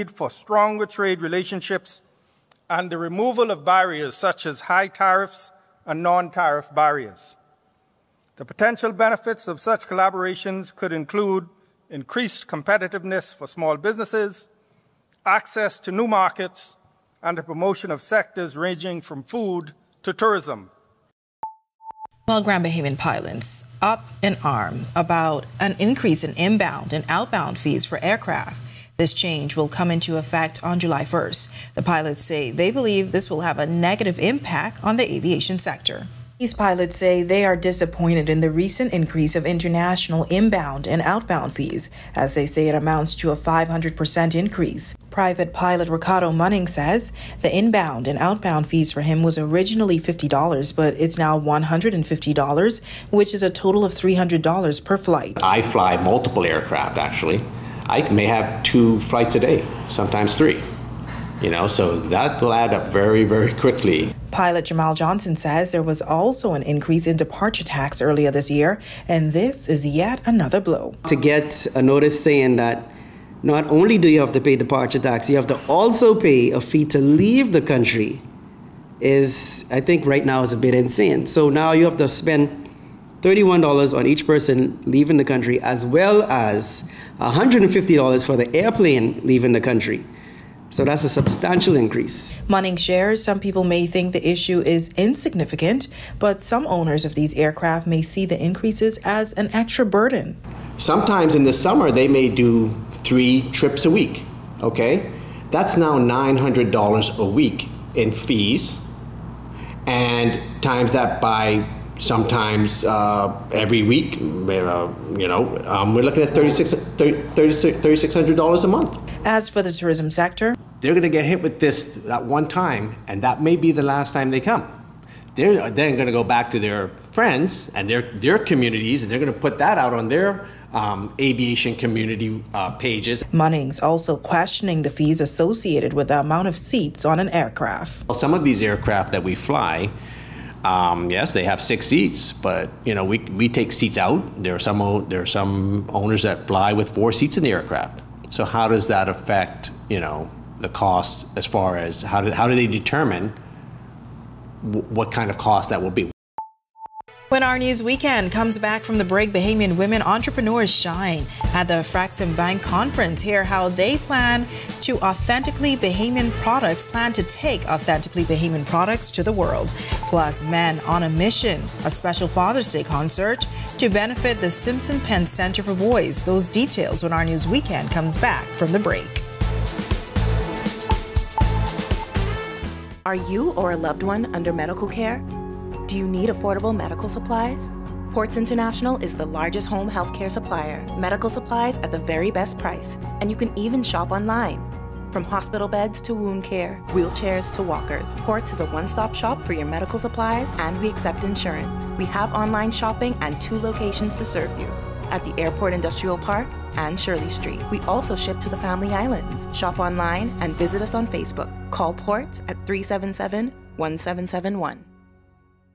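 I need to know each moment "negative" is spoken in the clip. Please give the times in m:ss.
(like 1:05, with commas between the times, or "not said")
0:33.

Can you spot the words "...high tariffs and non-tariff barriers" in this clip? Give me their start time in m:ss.
0:04.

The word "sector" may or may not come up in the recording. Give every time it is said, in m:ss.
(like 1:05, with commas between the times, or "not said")
0:17, 0:35, 2:00.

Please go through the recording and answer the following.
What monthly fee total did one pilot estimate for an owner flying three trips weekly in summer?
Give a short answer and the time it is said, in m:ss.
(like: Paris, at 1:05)
$3,600, at 1:56.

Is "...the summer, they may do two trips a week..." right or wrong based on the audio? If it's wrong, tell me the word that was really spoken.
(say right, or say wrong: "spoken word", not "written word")
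wrong: "three", not "two".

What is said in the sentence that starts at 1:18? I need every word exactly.
Is I think right now is a bit insane.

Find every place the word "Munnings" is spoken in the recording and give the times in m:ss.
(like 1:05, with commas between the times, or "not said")
0:46, 2:13.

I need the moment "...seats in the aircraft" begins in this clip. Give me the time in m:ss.
2:27.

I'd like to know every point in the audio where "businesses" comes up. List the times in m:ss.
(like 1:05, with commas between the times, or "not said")
0:13.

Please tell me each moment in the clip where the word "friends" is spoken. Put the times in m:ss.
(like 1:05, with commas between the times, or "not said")
2:07.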